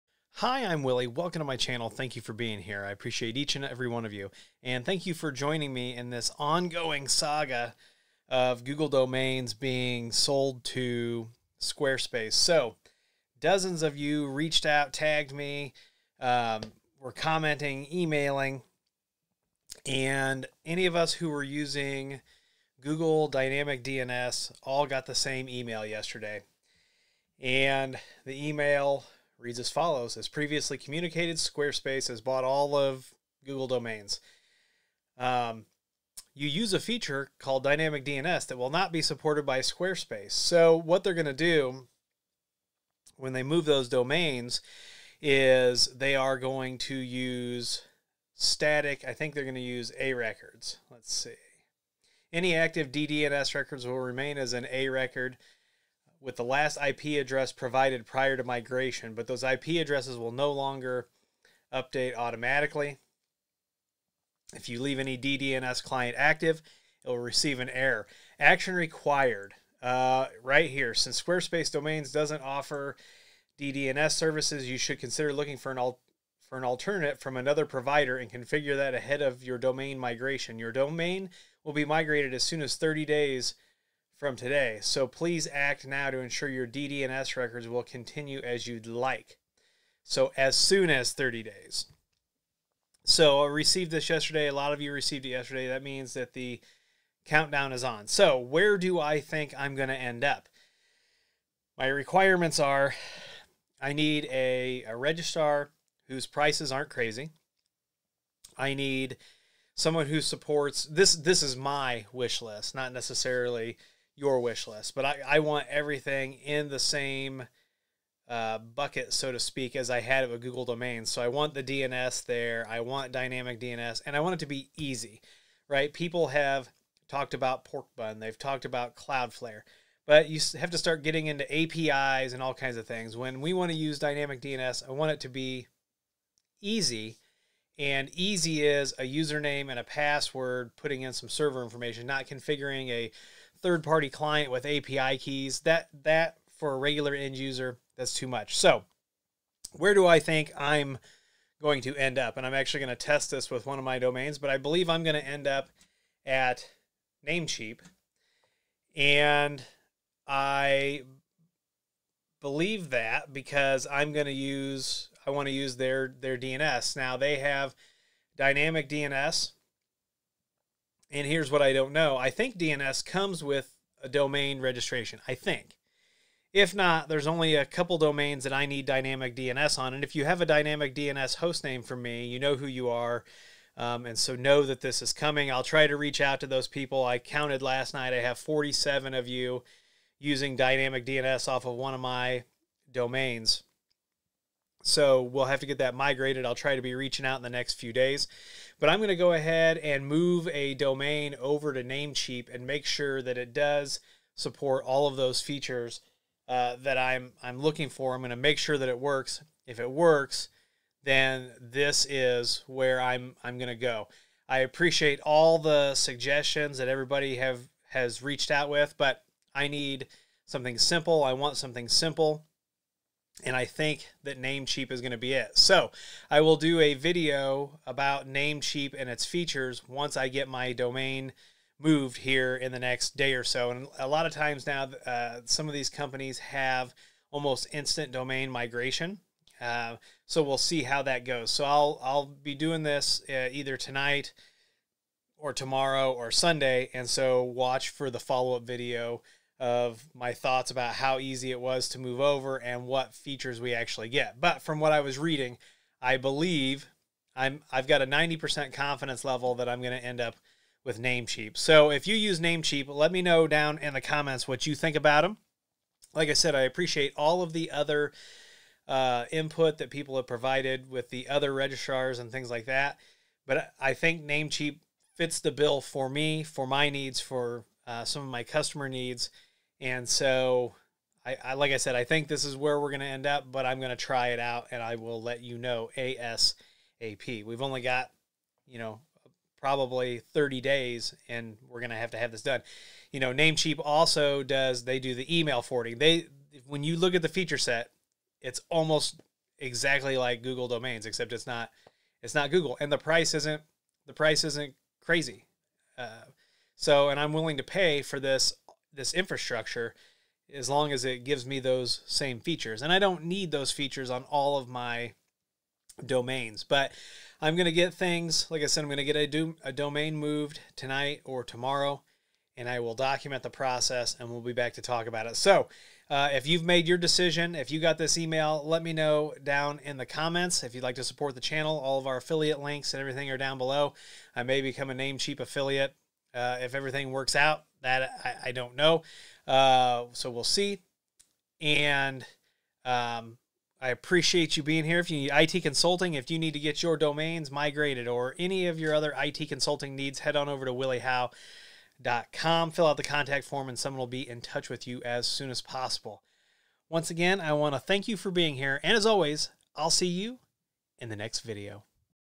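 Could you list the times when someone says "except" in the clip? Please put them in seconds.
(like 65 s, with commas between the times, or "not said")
301 s.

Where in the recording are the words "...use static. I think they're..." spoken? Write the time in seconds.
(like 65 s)
46 s.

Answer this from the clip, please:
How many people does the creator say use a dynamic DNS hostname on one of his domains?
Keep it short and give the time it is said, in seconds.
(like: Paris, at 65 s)
47, at 188 s.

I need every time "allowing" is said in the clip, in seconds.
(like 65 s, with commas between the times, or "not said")
not said.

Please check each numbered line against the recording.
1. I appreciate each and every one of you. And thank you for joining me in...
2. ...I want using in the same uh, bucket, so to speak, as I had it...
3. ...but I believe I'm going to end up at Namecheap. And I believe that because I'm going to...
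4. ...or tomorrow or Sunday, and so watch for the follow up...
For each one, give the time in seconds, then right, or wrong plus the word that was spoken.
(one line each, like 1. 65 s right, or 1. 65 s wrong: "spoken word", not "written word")
1. 2 s right
2. 115 s wrong: "everything", not "using"
3. 154 s right
4. 245 s right.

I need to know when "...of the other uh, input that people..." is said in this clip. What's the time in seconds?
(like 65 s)
267 s.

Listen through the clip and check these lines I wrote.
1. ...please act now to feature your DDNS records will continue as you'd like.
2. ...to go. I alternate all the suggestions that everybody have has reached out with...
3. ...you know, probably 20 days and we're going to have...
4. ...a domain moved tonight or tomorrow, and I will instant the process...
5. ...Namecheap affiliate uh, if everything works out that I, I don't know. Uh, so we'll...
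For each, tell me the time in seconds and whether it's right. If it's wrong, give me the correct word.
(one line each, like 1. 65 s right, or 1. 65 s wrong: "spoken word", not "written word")
1. 85 s wrong: "ensure", not "feature"
2. 213 s wrong: "appreciate", not "alternate"
3. 288 s wrong: "30", not "20"
4. 319 s wrong: "document", not "instant"
5. 334 s right.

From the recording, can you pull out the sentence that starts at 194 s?
So we'll have to get that migrated.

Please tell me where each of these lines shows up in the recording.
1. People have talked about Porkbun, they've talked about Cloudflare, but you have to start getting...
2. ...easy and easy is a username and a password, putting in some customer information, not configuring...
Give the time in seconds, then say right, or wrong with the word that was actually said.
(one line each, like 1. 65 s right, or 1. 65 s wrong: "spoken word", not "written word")
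1. 125 s right
2. 136 s wrong: "server", not "customer".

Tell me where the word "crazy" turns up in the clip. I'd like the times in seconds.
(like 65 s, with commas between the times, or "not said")
106 s, 305 s.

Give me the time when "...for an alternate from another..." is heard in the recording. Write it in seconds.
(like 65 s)
76 s.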